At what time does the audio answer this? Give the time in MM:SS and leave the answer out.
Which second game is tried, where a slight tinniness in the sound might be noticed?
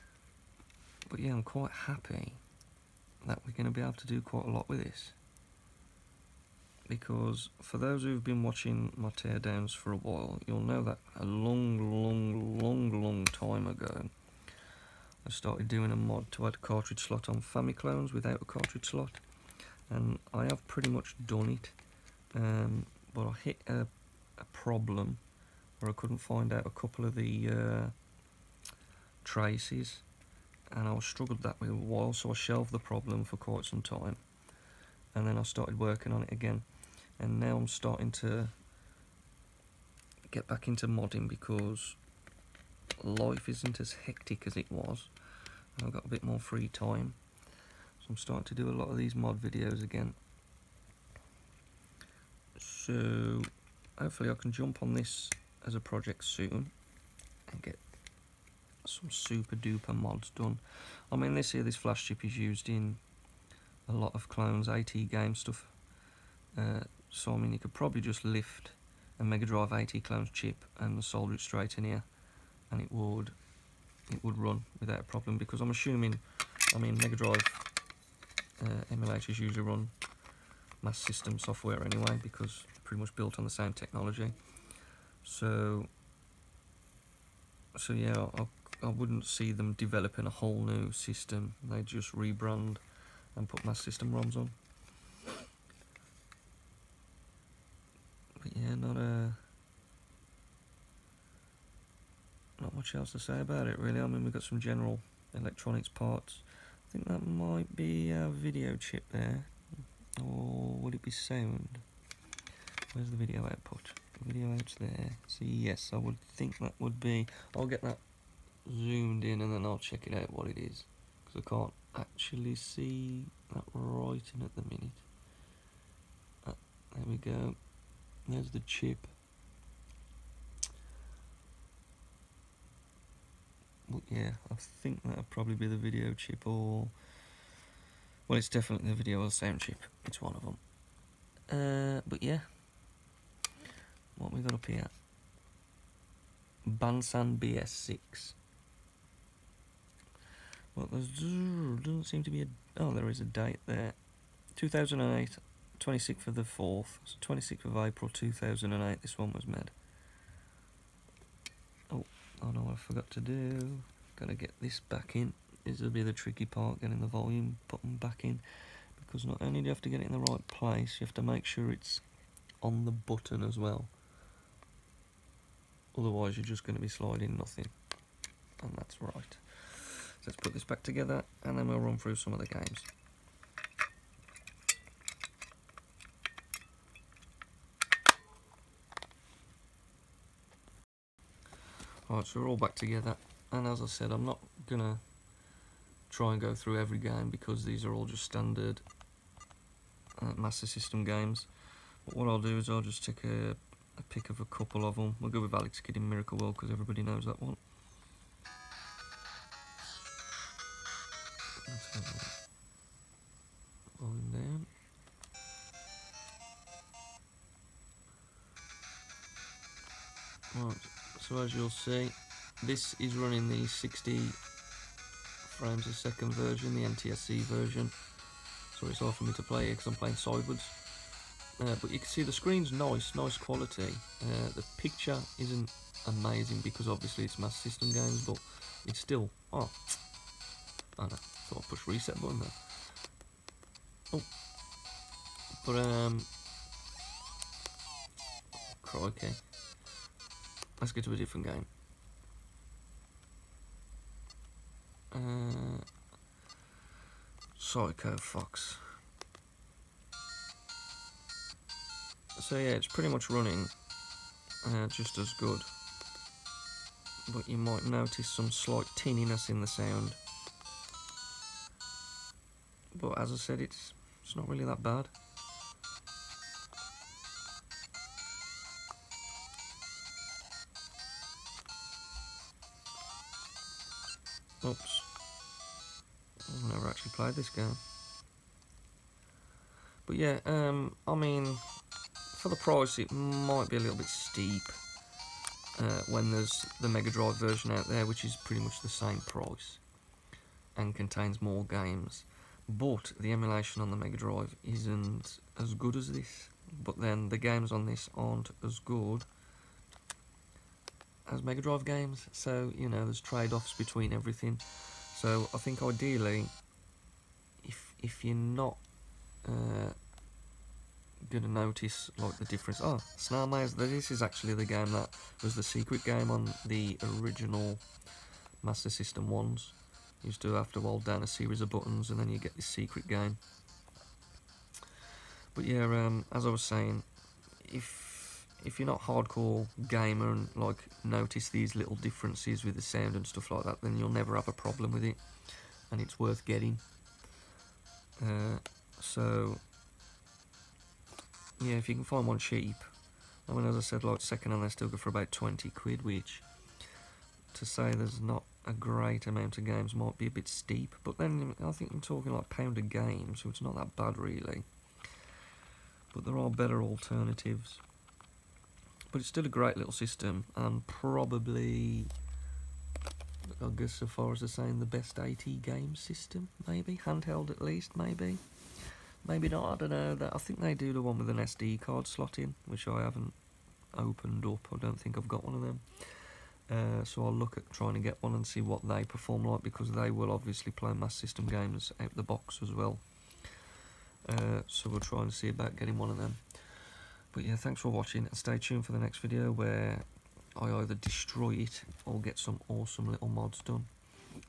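04:17.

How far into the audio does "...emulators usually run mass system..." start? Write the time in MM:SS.
01:18.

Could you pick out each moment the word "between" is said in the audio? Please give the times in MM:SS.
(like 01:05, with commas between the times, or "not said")
05:13.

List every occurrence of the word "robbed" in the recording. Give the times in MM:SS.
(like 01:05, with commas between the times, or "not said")
not said.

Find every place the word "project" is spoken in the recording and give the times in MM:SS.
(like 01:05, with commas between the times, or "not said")
00:55.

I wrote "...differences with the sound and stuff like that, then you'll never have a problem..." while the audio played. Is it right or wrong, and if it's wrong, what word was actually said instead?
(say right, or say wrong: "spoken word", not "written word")
right.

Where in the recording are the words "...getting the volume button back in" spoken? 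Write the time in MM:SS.
02:46.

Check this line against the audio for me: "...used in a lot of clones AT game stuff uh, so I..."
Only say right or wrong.
right.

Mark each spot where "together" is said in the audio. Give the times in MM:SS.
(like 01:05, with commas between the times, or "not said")
03:00, 03:12.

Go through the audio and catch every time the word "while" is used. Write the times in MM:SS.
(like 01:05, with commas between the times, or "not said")
00:09, 00:31.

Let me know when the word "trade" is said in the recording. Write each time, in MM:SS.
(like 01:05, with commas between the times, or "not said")
05:13.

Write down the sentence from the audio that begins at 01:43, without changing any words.
I mean, we've got some general electronics parts.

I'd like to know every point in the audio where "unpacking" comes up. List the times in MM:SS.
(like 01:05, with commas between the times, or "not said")
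not said.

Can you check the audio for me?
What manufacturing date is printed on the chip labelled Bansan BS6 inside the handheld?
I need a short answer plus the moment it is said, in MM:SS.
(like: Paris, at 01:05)
26th April 2008, at 02:37.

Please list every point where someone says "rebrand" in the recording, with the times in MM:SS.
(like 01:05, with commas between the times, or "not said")
01:32.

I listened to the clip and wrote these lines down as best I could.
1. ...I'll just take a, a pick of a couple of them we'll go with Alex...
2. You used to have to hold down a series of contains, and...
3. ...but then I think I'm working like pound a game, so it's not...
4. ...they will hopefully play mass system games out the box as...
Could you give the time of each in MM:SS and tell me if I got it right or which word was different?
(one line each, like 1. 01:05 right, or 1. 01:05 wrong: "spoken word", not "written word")
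1. 03:22 right
2. 05:30 wrong: "buttons", not "contains"
3. 06:01 wrong: "talking", not "working"
4. 06:29 wrong: "obviously", not "hopefully".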